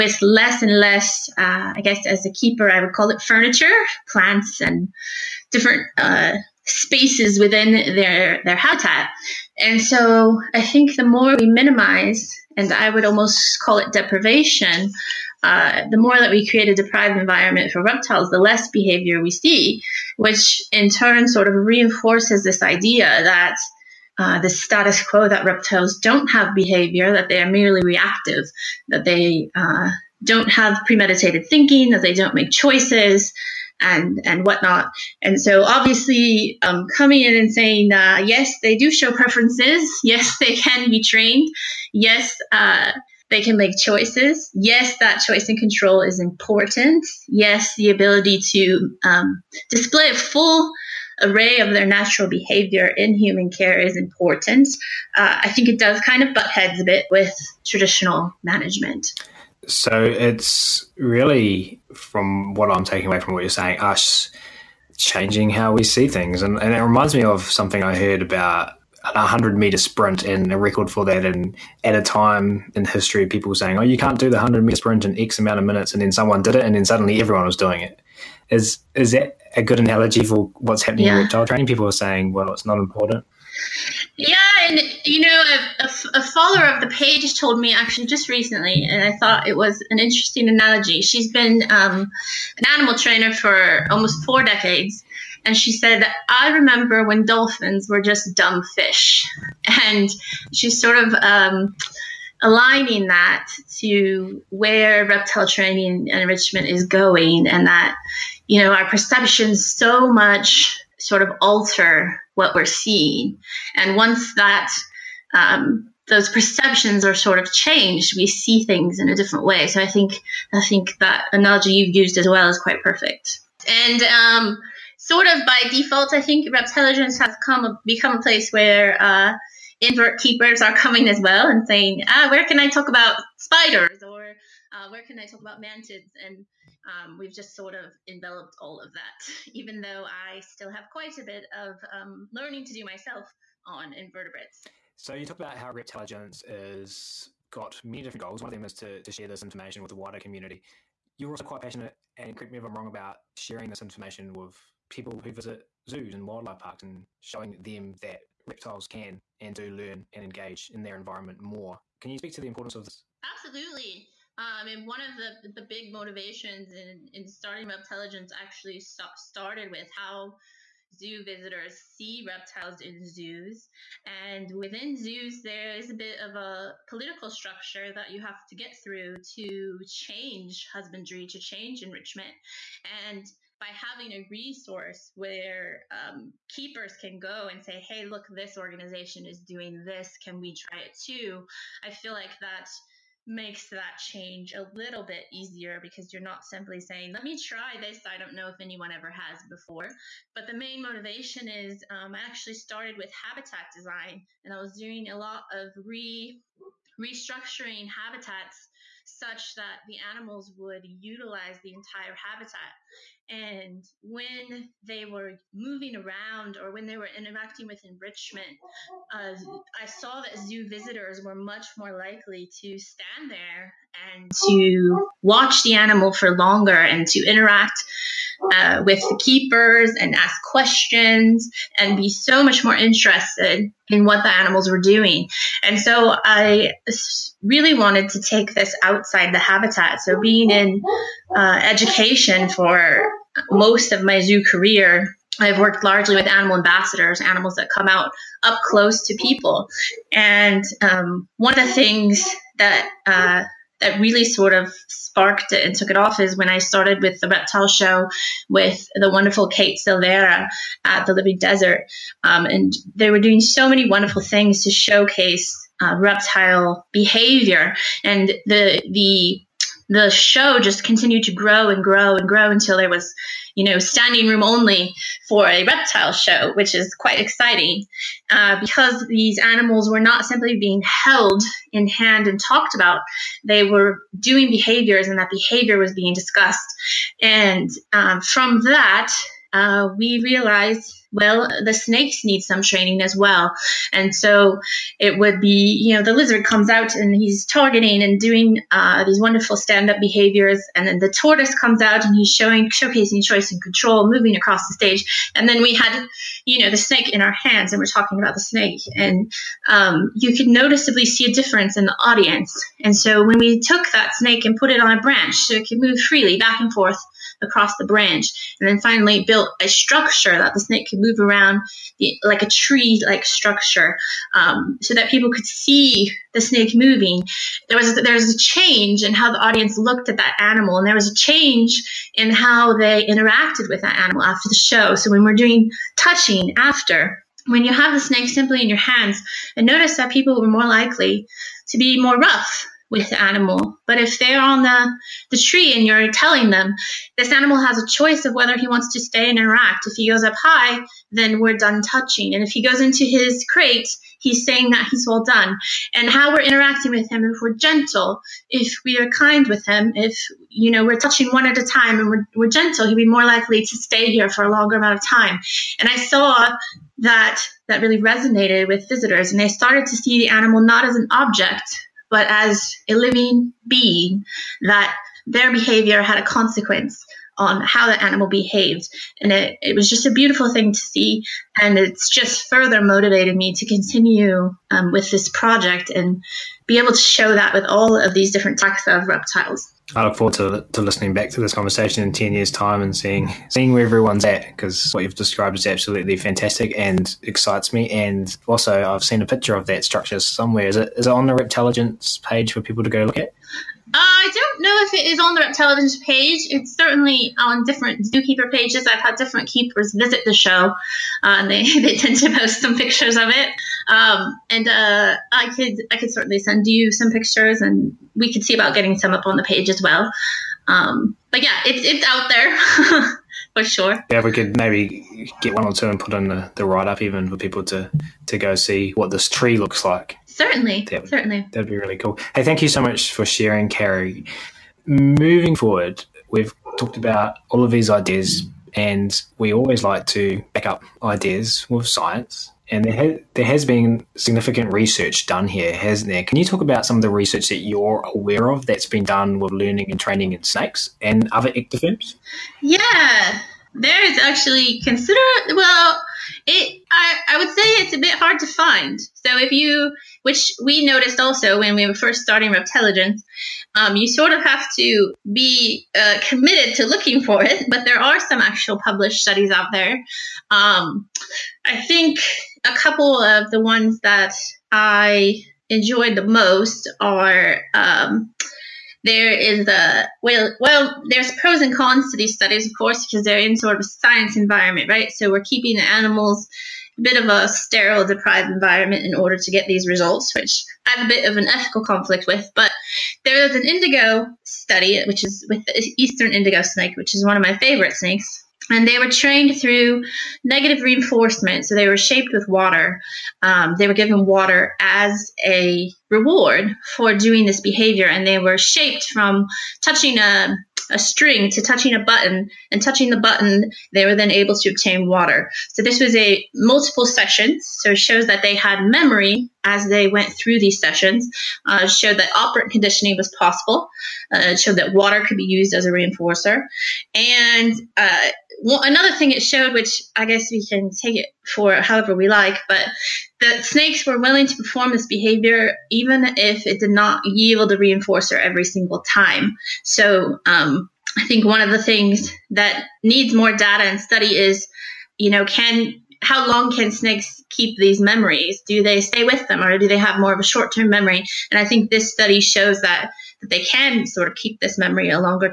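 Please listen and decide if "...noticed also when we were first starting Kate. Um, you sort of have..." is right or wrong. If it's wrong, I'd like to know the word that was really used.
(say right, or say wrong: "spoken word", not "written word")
wrong: "Reptelligence", not "Kate".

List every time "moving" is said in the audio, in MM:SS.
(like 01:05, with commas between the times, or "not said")
03:35, 05:04, 05:26, 07:14.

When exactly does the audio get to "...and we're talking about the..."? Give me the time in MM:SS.
05:07.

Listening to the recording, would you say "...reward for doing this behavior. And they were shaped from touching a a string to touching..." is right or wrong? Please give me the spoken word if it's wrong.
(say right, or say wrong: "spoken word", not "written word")
right.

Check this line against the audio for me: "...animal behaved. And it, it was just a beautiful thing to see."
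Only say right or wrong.
right.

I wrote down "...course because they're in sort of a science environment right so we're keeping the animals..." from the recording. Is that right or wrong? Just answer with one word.
right.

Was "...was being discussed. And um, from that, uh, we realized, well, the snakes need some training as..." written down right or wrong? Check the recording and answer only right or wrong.
right.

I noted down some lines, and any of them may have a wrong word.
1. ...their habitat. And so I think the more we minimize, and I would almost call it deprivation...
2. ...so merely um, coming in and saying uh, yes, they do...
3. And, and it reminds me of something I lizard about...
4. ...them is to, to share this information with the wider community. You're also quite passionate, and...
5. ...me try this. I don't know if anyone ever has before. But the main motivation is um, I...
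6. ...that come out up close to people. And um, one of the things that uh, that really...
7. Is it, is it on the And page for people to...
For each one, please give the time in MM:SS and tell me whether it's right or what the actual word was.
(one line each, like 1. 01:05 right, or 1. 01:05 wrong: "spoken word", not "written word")
1. 00:08 right
2. 00:35 wrong: "obviously", not "merely"
3. 01:06 wrong: "heard", not "lizard"
4. 02:28 right
5. 03:17 right
6. 04:07 right
7. 06:40 wrong: "Reptelligence", not "And".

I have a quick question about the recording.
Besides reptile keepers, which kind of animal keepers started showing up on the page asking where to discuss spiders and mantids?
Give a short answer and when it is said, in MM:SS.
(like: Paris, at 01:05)
invert keepers, at 02:09.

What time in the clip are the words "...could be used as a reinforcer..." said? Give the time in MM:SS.
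08:45.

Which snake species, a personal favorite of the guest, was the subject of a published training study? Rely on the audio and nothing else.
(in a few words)
eastern indigo snake.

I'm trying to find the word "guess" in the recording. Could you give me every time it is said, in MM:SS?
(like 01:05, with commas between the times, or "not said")
00:01, 08:50.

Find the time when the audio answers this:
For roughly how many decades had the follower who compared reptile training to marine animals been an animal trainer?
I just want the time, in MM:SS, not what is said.
01:34.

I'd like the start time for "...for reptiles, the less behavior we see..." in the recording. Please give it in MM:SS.
00:17.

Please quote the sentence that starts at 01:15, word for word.
And then someone did it, and then suddenly everyone was doing it.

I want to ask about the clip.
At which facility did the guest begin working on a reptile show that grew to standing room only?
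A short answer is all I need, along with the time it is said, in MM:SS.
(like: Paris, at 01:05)
the Living Desert, at 04:21.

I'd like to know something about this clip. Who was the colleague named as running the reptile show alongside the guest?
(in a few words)
Kate Silvera.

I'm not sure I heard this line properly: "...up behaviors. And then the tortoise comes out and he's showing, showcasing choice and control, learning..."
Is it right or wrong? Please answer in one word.
wrong.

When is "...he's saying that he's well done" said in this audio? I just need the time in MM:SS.
05:54.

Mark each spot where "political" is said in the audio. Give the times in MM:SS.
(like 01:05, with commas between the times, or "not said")
02:56.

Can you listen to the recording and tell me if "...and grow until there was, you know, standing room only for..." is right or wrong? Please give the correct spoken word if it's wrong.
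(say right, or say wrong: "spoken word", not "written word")
right.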